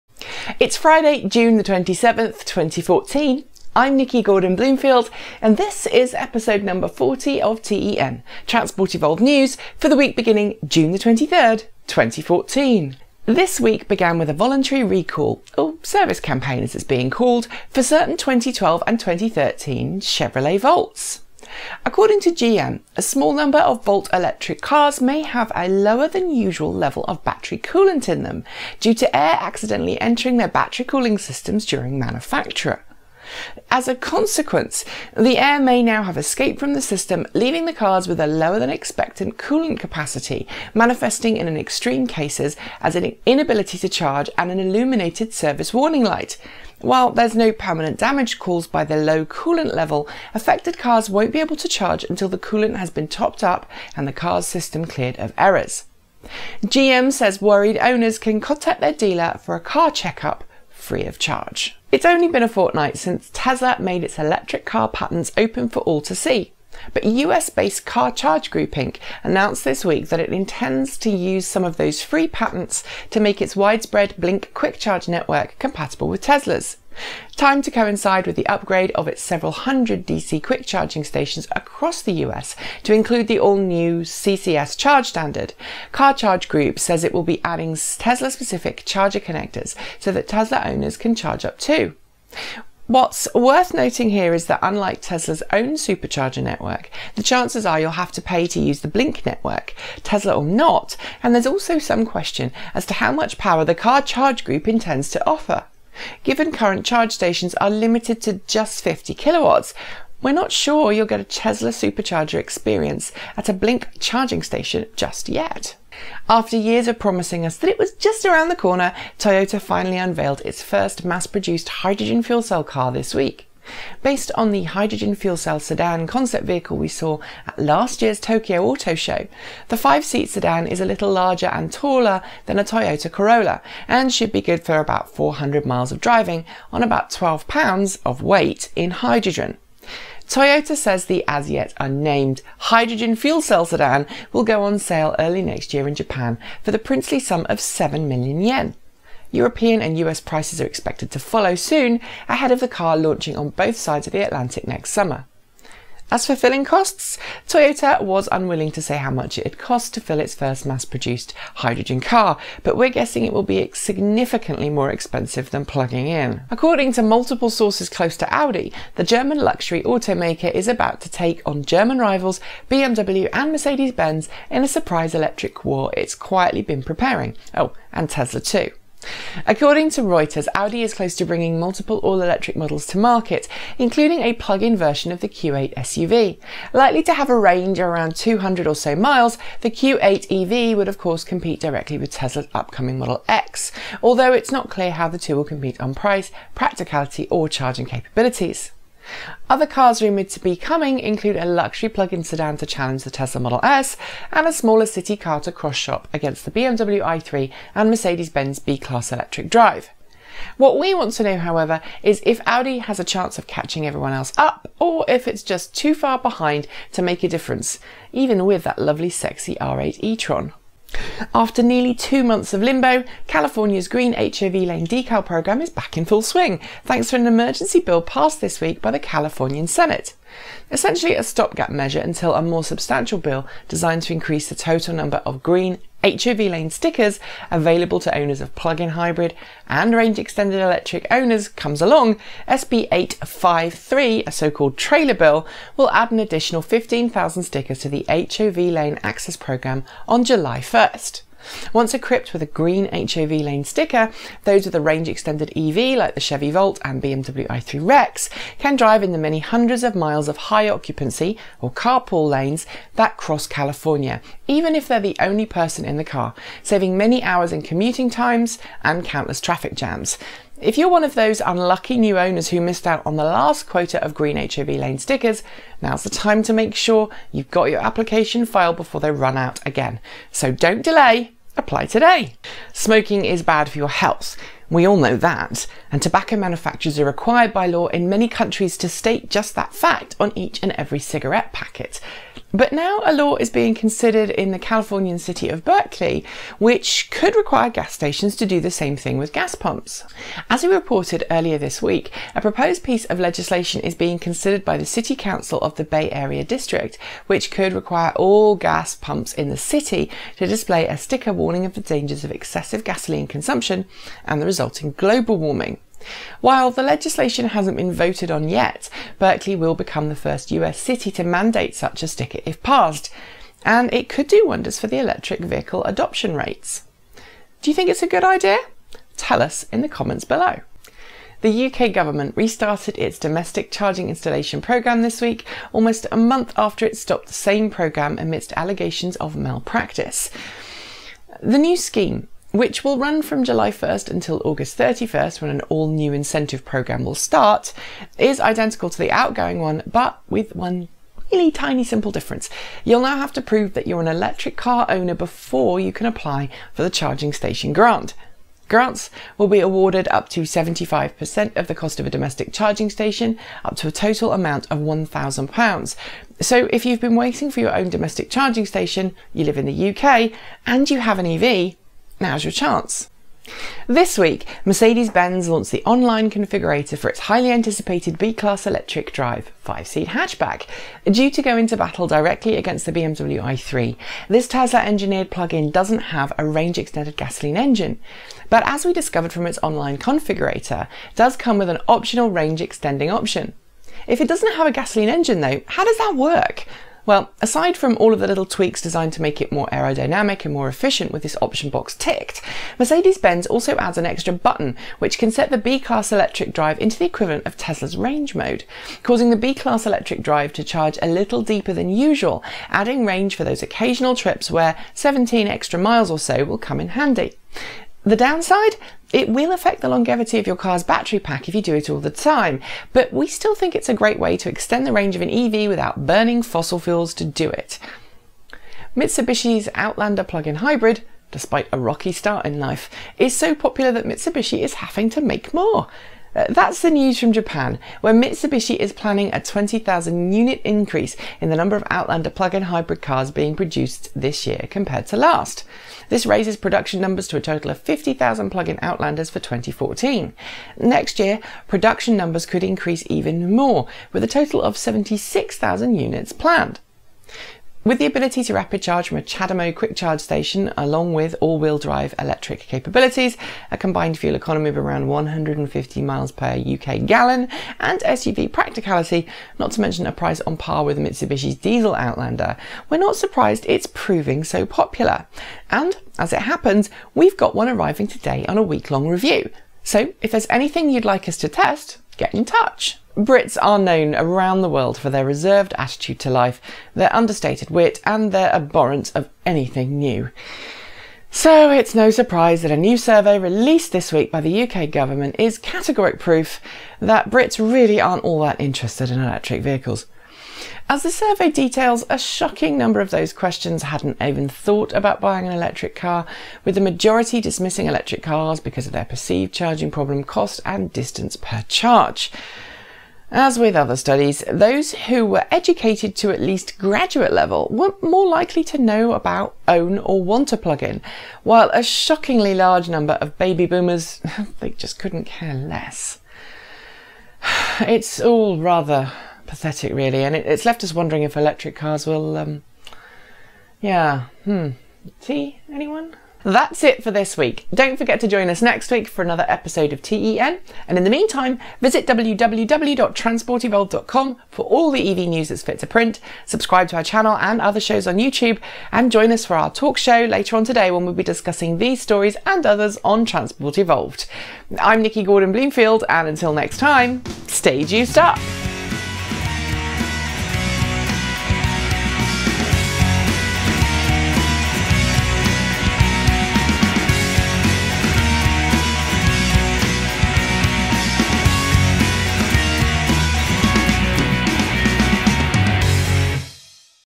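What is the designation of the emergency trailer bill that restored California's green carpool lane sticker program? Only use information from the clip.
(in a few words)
SB 853.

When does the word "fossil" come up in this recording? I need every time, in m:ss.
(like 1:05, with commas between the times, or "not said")
7:06.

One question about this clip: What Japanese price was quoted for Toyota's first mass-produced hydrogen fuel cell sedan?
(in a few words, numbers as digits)
7 million yen.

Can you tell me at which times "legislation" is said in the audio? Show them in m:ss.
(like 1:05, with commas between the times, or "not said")
5:03, 5:16.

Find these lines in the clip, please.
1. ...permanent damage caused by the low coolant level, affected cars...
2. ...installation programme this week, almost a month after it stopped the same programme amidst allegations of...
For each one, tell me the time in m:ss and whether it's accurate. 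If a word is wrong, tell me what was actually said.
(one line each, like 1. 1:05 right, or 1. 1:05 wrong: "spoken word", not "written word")
1. 0:47 right
2. 5:34 right.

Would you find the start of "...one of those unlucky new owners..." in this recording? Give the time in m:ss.
4:30.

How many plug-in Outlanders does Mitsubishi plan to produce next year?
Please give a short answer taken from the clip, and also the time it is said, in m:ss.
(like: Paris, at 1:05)
76,000, at 7:34.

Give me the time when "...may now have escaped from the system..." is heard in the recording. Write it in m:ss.
0:35.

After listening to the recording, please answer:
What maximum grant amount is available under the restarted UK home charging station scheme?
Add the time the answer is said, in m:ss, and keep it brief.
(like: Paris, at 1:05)
£1,000, at 6:04.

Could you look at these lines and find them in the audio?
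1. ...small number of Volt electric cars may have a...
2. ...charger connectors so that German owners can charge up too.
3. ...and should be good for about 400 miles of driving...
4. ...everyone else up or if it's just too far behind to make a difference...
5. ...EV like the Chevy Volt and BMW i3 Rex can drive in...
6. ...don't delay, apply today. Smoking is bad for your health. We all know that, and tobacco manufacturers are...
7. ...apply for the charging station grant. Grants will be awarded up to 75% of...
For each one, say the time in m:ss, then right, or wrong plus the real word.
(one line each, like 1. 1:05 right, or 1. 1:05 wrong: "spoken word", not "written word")
1. 0:23 right
2. 1:28 wrong: "Tesla", not "German"
3. 2:13 right
4. 3:33 right
5. 4:15 right
6. 4:40 right
7. 5:56 right.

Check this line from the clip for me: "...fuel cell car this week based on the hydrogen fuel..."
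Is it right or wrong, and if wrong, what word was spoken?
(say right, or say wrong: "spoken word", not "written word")
right.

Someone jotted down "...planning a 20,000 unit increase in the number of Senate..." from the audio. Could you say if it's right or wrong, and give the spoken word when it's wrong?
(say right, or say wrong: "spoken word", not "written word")
wrong: "Outlander", not "Senate".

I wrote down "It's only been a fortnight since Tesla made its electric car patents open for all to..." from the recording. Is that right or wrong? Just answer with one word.
right.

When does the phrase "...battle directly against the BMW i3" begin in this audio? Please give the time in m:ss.
6:21.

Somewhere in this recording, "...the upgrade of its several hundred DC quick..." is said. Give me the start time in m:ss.
1:18.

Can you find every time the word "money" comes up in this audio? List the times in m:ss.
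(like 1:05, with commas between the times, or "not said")
not said.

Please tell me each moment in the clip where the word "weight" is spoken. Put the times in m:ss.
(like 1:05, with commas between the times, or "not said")
2:18.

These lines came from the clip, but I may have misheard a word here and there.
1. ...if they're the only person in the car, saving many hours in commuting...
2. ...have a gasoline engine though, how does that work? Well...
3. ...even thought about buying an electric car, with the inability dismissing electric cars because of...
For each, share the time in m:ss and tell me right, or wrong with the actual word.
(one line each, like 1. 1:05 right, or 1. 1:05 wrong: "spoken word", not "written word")
1. 4:24 right
2. 6:34 right
3. 8:24 wrong: "majority", not "inability".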